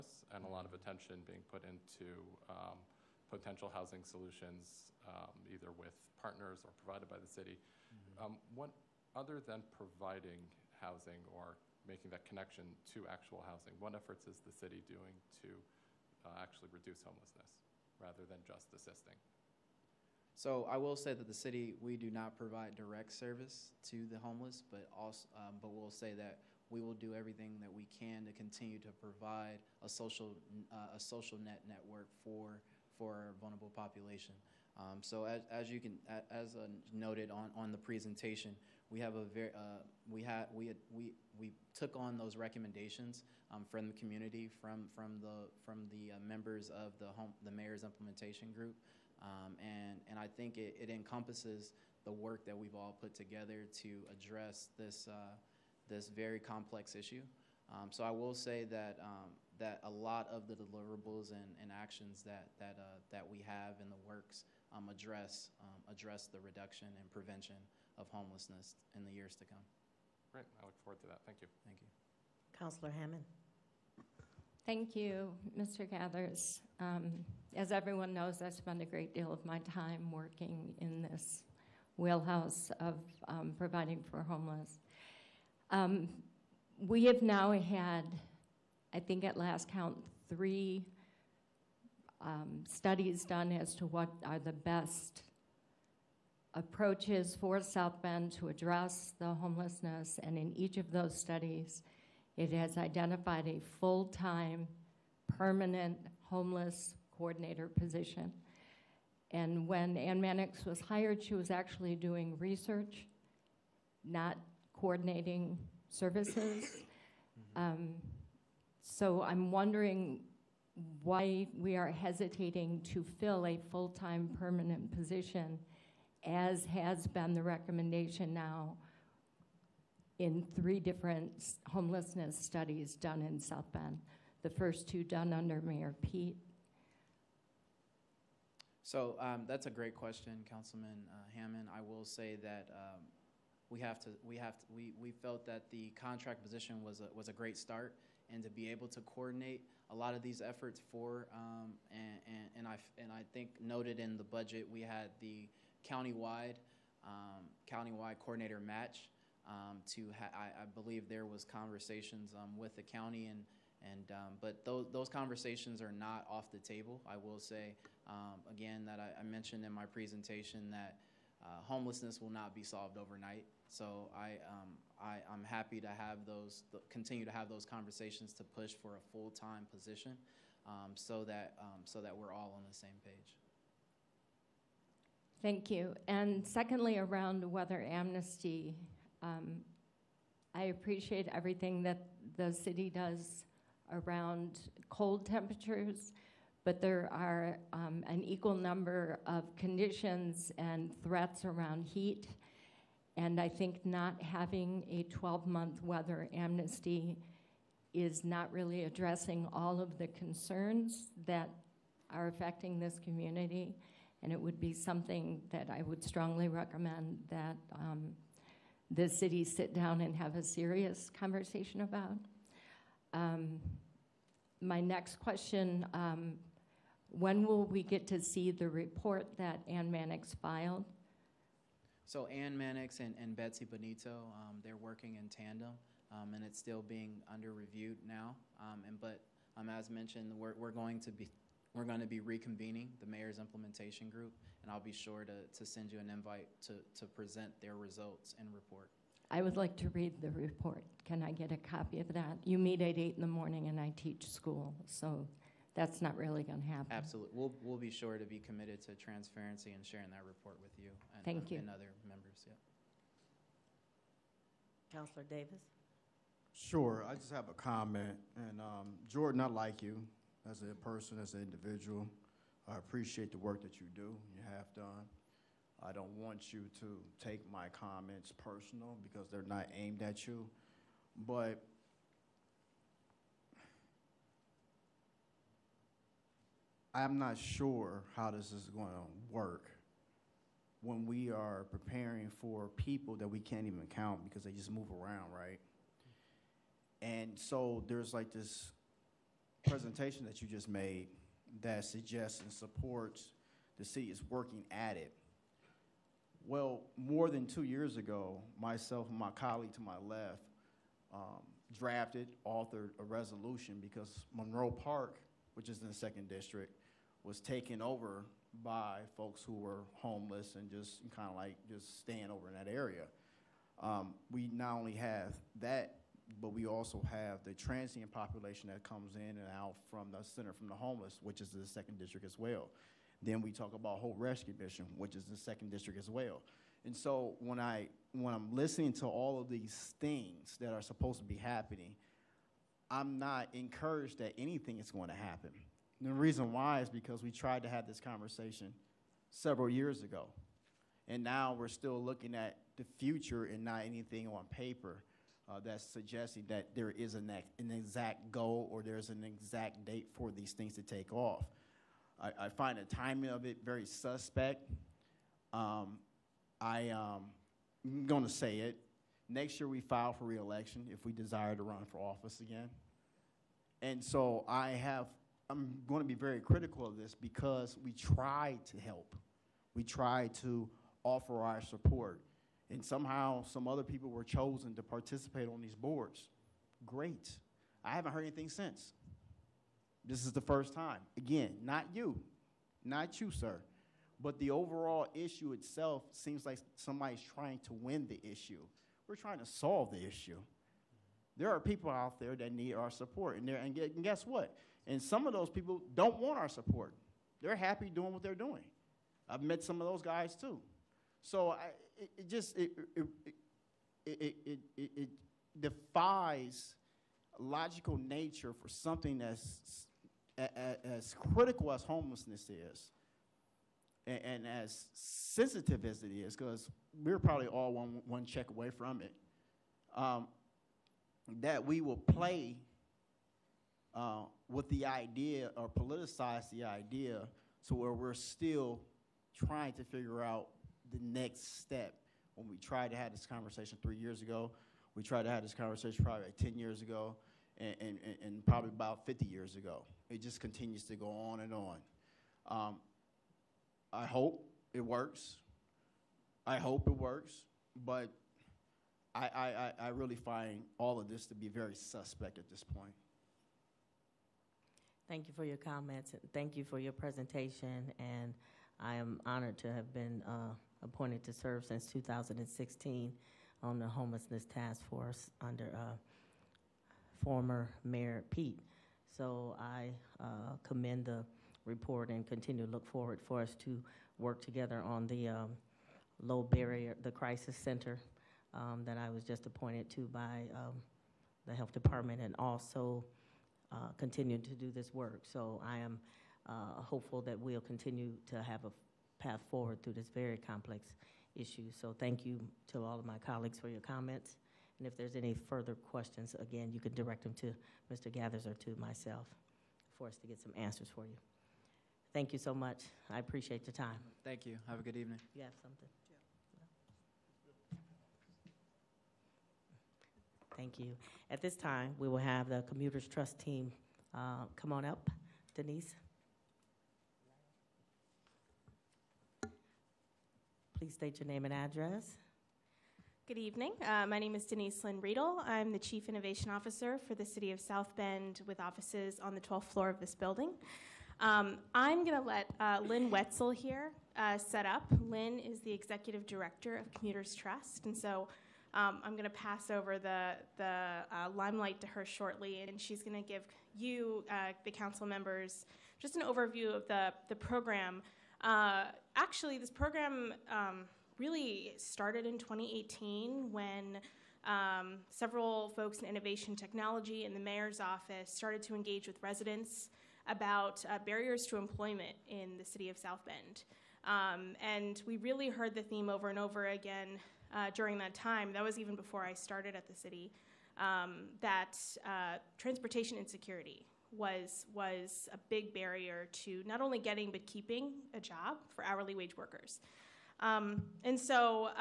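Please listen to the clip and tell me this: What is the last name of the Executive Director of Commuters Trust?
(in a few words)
Wetzel.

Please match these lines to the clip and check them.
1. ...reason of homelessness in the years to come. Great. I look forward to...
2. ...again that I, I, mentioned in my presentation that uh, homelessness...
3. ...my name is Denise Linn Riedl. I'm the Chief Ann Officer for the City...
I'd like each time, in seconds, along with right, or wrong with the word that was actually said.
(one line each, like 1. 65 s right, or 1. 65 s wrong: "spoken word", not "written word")
1. 67 s wrong: "prevention", not "reason"
2. 168 s right
3. 534 s wrong: "Innovation", not "Ann".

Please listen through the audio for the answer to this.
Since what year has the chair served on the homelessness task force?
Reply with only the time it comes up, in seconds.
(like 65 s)
471 s.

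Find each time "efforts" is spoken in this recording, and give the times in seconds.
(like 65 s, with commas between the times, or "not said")
13 s, 150 s.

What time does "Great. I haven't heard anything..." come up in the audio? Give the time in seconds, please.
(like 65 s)
386 s.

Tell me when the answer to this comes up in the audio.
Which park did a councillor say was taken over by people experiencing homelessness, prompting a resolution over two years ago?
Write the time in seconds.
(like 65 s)
314 s.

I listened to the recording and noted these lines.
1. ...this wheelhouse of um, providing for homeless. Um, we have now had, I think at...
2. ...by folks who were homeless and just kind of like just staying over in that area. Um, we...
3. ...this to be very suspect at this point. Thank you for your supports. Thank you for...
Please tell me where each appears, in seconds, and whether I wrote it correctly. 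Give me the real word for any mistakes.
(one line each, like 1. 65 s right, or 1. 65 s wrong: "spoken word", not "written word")
1. 81 s right
2. 318 s right
3. 461 s wrong: "comments", not "supports".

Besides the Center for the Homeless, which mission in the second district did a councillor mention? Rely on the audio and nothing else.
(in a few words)
Hope Rescue Mission.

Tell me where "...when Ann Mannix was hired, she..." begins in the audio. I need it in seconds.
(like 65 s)
109 s.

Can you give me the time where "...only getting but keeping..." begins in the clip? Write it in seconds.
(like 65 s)
586 s.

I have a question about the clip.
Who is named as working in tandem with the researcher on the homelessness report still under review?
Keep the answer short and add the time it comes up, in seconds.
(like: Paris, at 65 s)
Betsy Bonito, at 233 s.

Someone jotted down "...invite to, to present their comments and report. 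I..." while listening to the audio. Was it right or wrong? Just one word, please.
wrong.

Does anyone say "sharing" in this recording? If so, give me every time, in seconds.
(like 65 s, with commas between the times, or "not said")
259 s.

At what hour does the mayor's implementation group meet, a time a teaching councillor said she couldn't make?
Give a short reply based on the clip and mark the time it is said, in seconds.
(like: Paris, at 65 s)
8 in the morning, at 252 s.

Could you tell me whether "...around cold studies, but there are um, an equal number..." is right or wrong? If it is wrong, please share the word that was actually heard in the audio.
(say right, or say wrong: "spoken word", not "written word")
wrong: "temperatures", not "studies".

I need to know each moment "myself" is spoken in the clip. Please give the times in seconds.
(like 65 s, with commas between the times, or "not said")
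308 s, 508 s.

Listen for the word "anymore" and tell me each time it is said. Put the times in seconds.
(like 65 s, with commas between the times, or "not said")
not said.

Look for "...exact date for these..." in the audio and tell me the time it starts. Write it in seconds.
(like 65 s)
359 s.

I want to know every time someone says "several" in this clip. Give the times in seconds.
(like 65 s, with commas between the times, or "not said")
349 s, 565 s.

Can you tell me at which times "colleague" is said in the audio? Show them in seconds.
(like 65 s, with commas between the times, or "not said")
309 s, 503 s.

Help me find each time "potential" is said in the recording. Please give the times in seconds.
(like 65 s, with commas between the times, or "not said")
3 s.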